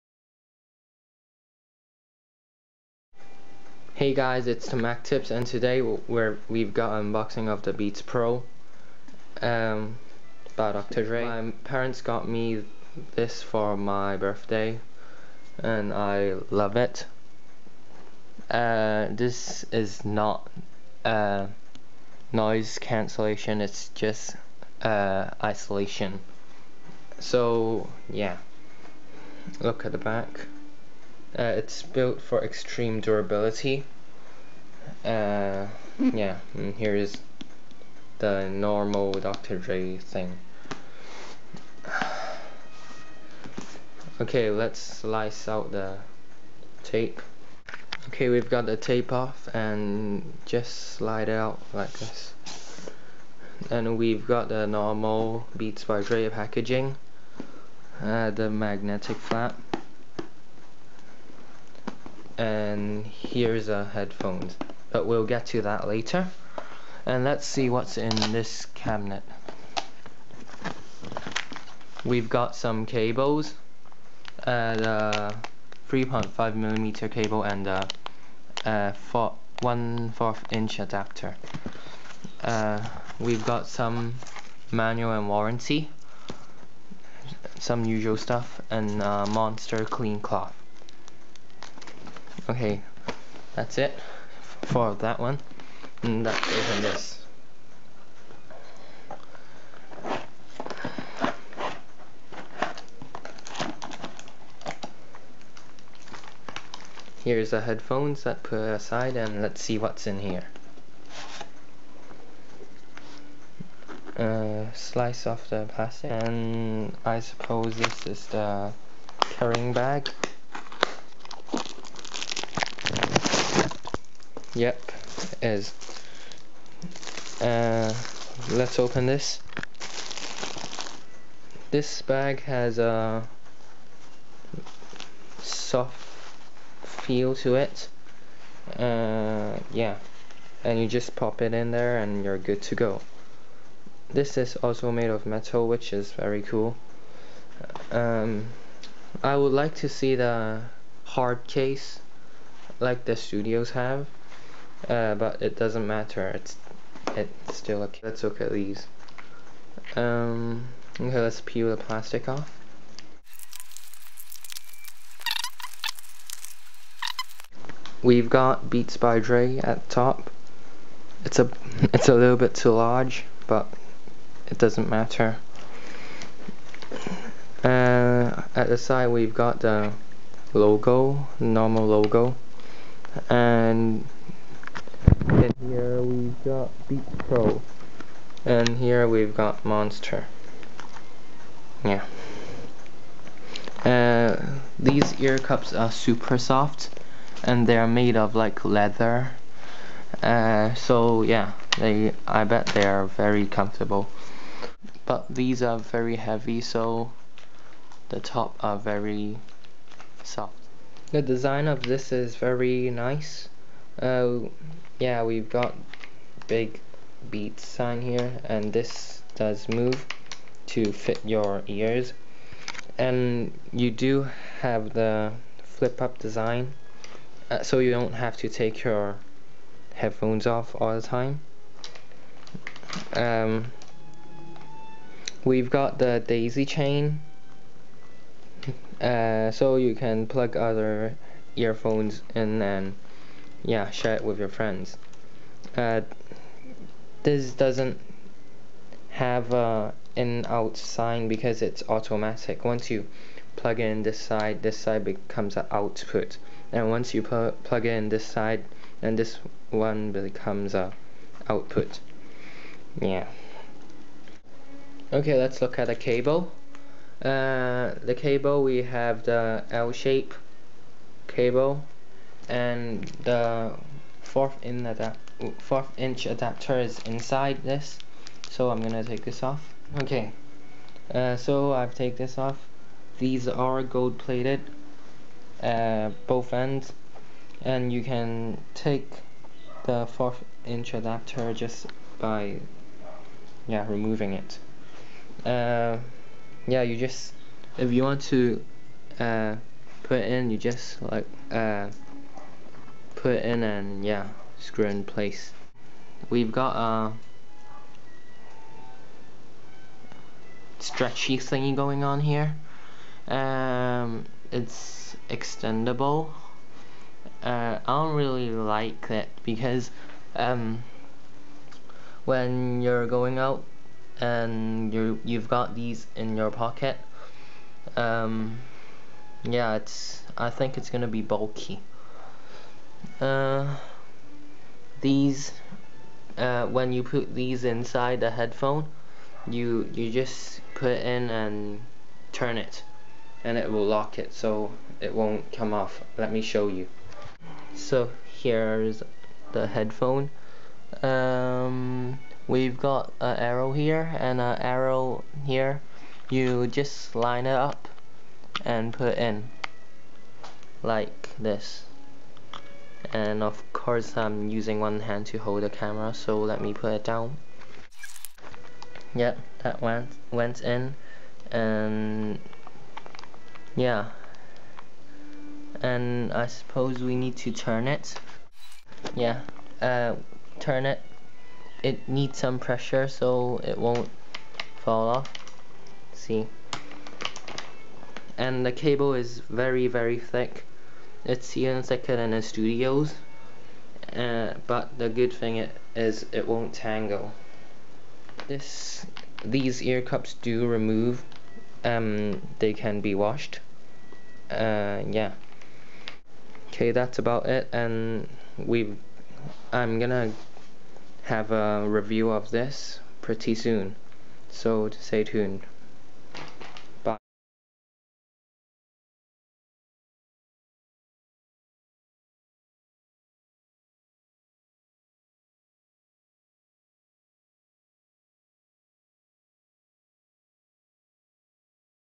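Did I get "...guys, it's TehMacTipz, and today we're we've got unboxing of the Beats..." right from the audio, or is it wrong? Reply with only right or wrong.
right.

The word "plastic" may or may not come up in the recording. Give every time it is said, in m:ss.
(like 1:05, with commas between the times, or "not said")
1:55, 2:41.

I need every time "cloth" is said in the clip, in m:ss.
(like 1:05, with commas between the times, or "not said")
1:30.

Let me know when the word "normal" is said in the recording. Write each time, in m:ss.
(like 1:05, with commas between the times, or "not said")
0:38, 0:54, 3:01.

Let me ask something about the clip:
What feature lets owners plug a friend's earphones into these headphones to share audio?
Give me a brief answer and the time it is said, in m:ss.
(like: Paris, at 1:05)
Daisy chain, at 3:56.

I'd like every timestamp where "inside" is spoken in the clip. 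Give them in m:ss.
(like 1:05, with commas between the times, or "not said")
4:36, 5:37.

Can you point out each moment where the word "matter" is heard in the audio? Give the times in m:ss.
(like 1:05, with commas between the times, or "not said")
2:35, 2:54.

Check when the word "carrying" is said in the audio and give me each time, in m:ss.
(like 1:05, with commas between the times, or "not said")
1:59.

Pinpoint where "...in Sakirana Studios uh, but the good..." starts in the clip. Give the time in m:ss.
6:31.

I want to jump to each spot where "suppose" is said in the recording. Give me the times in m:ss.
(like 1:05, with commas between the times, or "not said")
1:57, 6:16.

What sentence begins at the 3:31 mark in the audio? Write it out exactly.
The design of this is very nice.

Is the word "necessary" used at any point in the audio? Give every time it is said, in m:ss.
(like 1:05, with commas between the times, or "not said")
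not said.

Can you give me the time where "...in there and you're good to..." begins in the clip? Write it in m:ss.
2:21.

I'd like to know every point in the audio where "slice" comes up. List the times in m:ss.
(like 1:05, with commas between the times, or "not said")
0:44, 1:54.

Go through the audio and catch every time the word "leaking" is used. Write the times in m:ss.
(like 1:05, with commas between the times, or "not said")
not said.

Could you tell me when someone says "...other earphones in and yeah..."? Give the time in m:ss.
4:00.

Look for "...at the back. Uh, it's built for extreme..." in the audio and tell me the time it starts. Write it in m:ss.
0:29.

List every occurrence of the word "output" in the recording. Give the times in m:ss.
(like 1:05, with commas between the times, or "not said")
4:15, 4:21.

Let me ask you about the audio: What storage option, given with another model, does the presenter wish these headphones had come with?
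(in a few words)
Hard case.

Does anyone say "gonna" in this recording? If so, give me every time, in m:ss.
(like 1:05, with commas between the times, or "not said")
4:38, 5:30, 6:49.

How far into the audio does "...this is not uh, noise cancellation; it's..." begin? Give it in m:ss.
0:19.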